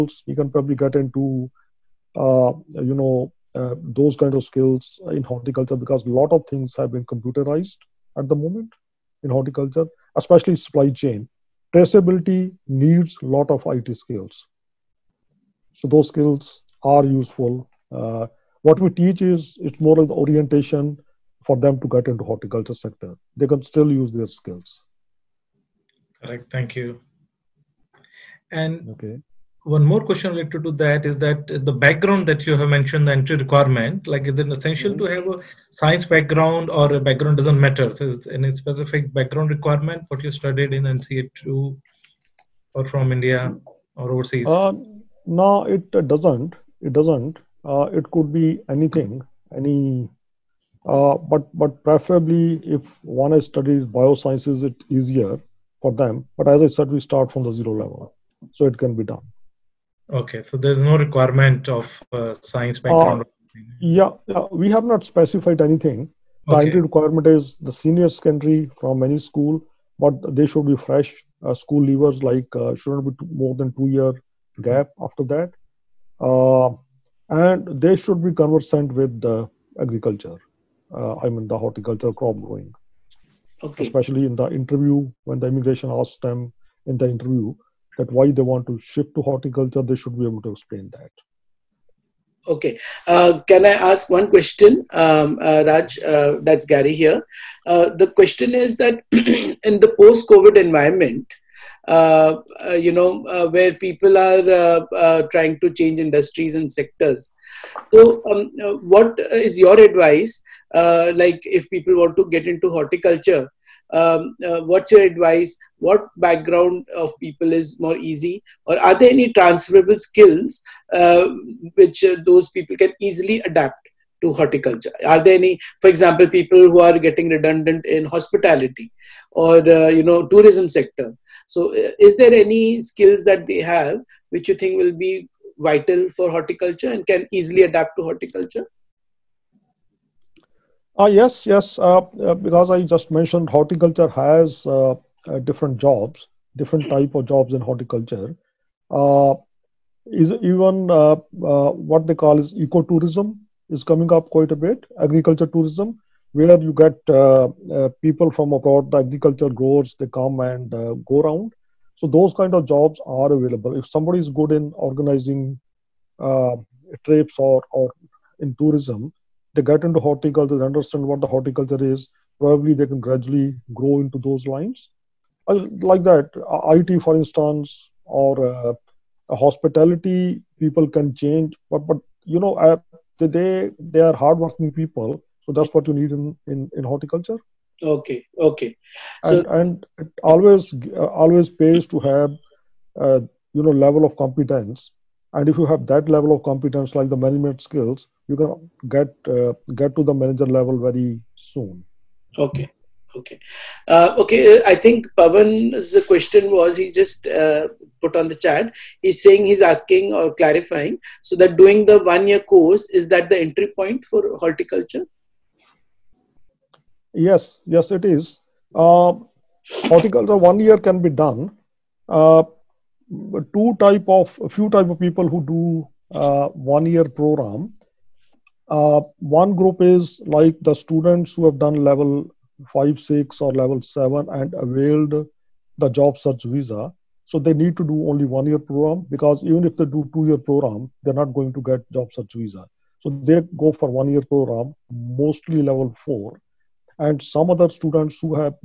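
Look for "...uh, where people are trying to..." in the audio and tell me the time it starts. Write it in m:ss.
1:43.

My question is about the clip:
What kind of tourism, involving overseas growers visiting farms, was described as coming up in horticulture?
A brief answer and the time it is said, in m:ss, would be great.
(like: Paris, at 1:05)
Ecotourism, at 2:32.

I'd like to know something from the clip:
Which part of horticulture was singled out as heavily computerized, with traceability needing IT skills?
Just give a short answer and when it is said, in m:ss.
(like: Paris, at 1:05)
Supply chain, at 0:10.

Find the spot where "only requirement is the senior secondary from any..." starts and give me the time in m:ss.
1:06.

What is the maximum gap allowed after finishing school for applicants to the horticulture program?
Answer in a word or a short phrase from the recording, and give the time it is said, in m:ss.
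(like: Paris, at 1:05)
2 years, at 1:13.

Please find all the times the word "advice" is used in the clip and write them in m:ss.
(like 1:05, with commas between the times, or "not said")
1:49, 1:55.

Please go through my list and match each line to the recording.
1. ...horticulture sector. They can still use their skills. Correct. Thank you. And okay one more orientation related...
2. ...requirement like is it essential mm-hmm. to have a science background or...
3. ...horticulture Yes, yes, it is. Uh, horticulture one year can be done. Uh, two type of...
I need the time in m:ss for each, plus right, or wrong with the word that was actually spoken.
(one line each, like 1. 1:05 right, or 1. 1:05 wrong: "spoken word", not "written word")
1. 0:22 wrong: "question", not "orientation"
2. 0:33 right
3. 3:34 right.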